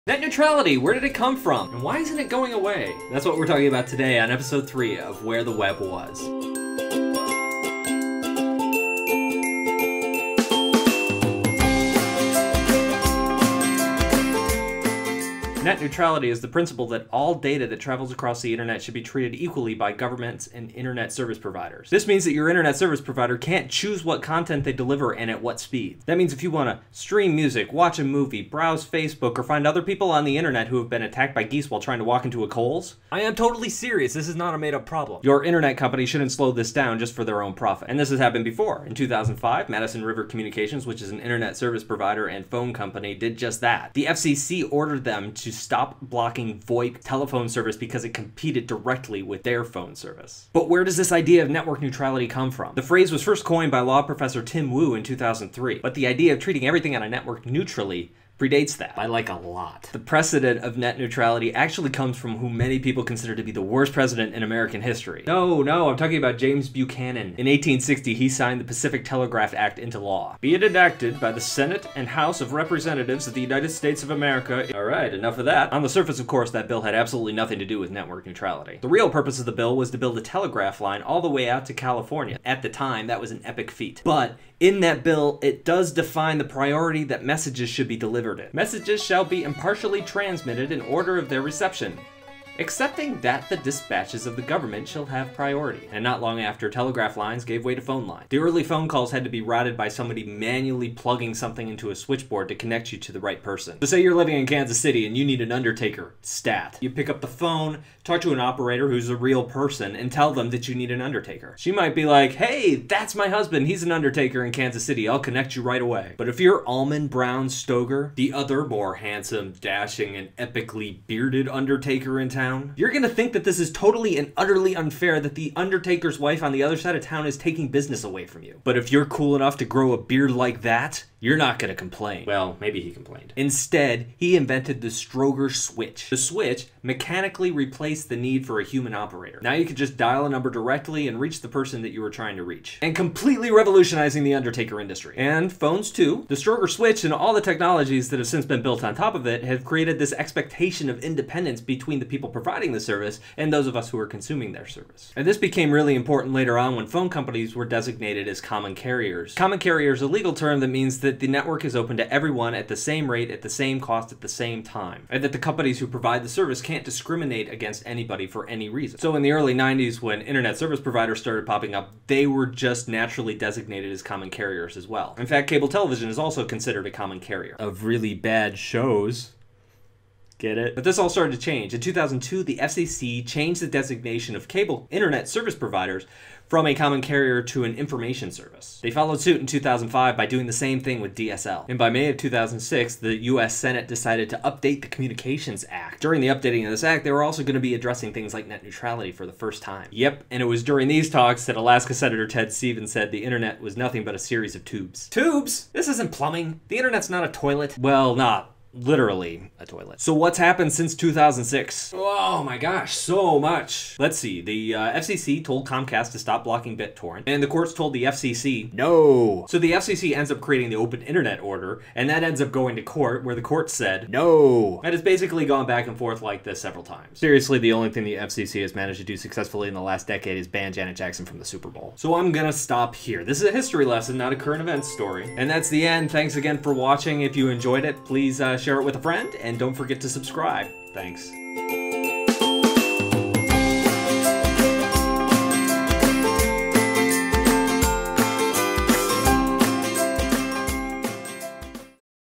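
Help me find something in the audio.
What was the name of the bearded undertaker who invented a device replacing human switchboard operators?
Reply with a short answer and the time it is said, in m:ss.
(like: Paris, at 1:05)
Almon Brown Strowger, at 1:56.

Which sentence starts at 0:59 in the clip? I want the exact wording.
The precedent of net neutrality actually comes from who many people consider to be the worst president in American history.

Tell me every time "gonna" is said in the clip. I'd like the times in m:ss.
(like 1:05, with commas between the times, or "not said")
2:02, 3:52.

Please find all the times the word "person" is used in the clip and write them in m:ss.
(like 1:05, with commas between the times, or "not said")
1:43, 1:49, 2:21.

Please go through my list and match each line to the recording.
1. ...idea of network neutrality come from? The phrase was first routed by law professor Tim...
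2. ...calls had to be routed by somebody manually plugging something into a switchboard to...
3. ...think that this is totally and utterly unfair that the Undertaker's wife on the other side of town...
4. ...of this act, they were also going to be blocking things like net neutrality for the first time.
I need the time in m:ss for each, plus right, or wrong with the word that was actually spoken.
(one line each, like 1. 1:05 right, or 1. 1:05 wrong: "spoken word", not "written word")
1. 0:51 wrong: "coined", not "routed"
2. 1:38 right
3. 2:03 right
4. 3:16 wrong: "addressing", not "blocking".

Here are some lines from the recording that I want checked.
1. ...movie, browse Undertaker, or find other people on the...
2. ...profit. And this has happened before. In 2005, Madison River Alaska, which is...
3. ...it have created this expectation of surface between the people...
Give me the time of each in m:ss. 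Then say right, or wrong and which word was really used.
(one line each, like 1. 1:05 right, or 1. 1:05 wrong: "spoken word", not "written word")
1. 0:28 wrong: "Facebook", not "Undertaker"
2. 0:37 wrong: "Communications", not "Alaska"
3. 2:29 wrong: "independence", not "surface".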